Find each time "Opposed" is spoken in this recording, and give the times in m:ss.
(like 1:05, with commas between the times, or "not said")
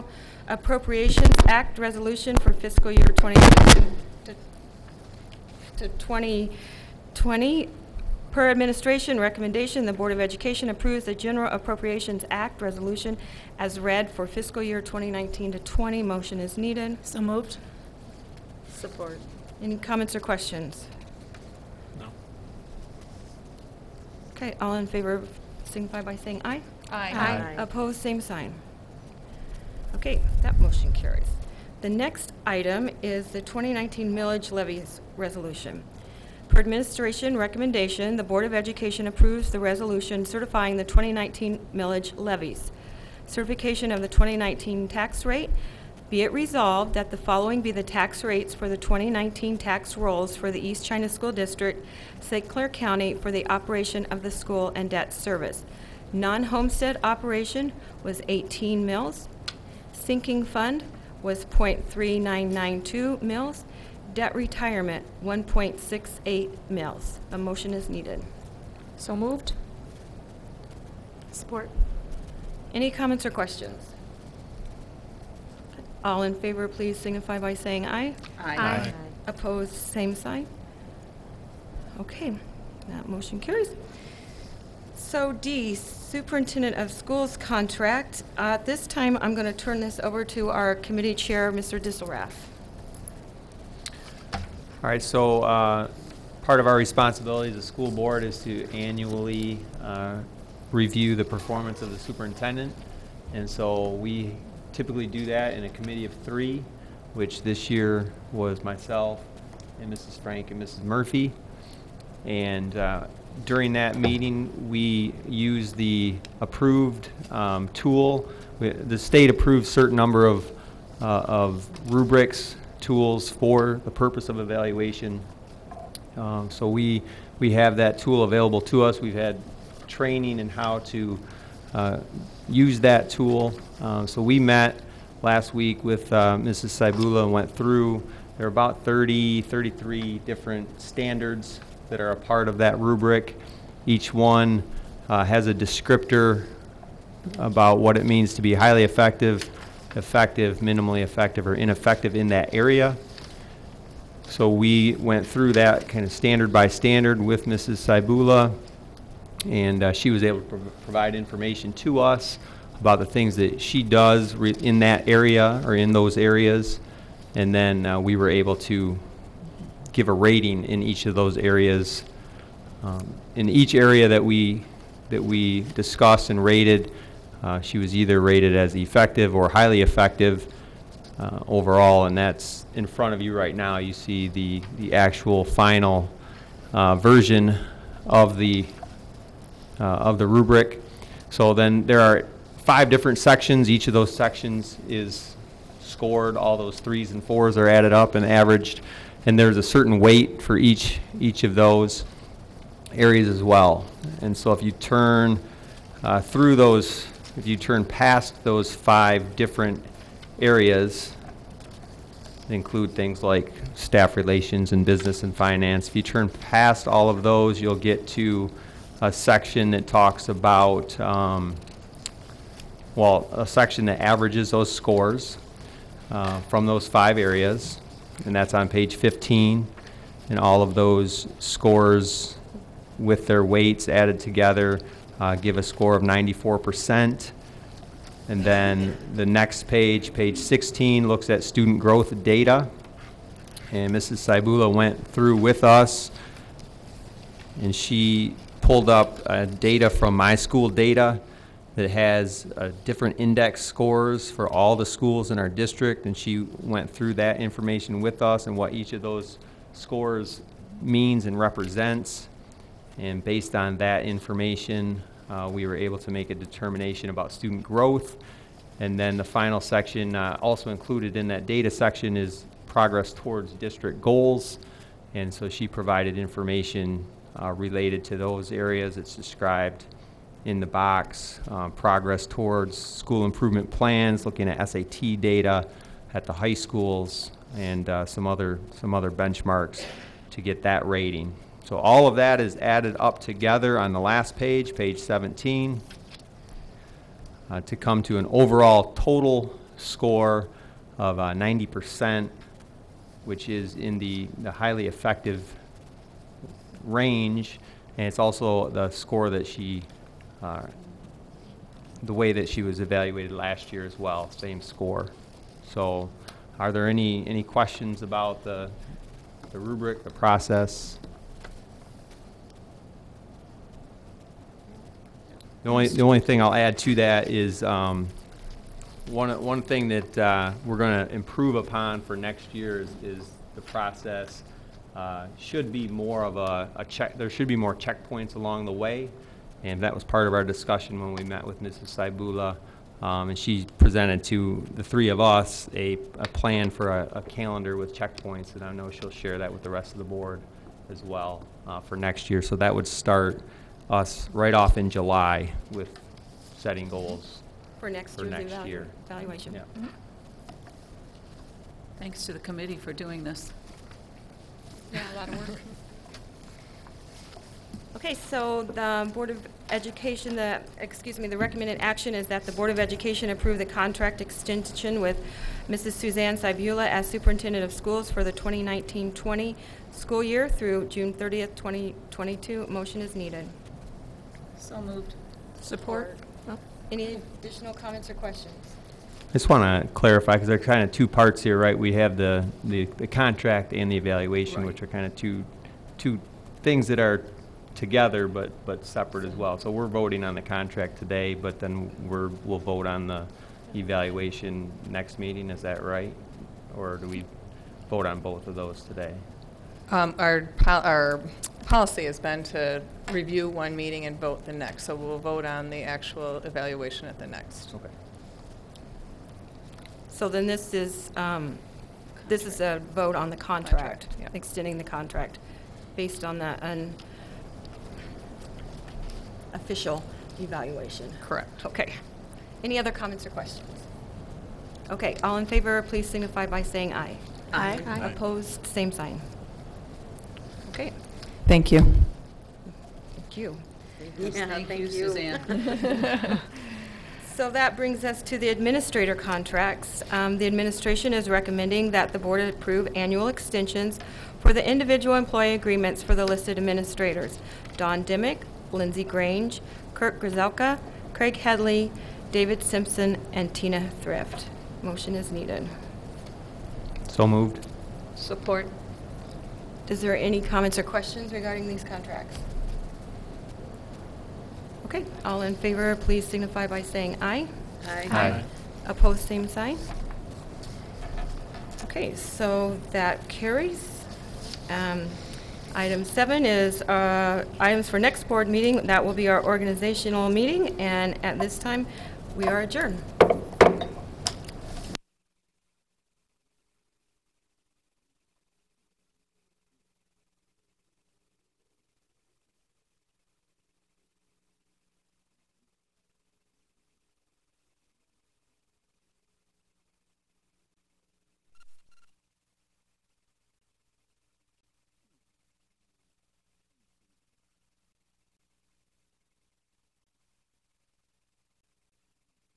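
0:27, 1:19, 7:18, 7:58.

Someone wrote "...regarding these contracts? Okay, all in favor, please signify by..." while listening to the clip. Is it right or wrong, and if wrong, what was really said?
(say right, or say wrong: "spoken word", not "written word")
right.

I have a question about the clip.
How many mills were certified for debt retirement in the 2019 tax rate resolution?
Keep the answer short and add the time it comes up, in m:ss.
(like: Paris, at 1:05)
1.68 mills, at 1:05.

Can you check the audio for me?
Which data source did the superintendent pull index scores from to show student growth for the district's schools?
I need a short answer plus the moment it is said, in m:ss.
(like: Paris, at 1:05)
MiSchoolData, at 4:10.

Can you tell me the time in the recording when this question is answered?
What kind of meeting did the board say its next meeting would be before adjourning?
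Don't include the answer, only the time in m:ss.
8:09.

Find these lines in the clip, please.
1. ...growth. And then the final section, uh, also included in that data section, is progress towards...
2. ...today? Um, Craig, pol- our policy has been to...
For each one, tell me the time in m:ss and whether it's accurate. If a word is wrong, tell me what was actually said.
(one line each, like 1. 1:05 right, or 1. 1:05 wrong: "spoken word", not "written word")
1. 4:27 right
2. 6:48 wrong: "Our", not "Craig".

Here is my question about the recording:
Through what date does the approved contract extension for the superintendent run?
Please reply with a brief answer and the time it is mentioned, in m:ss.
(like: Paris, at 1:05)
June 30, 2022, at 6:20.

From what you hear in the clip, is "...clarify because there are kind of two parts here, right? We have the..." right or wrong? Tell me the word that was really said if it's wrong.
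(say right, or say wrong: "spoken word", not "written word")
right.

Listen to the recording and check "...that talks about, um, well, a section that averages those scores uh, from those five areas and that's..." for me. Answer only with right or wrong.
right.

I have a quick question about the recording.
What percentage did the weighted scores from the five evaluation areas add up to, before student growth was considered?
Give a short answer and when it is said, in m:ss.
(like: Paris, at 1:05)
94%, at 3:56.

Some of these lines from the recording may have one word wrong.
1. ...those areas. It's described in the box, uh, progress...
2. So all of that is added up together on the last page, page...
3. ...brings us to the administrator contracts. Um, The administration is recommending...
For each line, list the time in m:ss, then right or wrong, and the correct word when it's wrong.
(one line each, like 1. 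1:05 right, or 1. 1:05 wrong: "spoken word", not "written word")
1. 4:38 right
2. 4:51 right
3. 7:27 right.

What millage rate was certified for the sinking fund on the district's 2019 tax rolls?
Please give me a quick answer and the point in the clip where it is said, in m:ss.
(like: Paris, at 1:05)
0.3992 mills, at 1:01.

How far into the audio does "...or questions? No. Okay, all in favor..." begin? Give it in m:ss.
0:20.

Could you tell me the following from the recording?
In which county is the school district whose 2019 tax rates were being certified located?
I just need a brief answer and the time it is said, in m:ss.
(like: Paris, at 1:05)
St. Clair County, at 0:52.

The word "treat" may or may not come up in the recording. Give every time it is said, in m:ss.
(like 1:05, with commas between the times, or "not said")
not said.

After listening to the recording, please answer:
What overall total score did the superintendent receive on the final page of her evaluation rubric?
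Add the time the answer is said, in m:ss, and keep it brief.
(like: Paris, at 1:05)
90%, at 5:01.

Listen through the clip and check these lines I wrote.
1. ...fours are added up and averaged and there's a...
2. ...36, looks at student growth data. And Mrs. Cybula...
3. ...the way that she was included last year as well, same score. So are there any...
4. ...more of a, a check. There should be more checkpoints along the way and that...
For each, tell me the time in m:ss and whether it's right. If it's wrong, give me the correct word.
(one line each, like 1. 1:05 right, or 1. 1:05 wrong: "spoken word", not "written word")
1. 3:17 right
2. 4:00 wrong: "16", not "36"
3. 5:12 wrong: "evaluated", not "included"
4. 5:35 right.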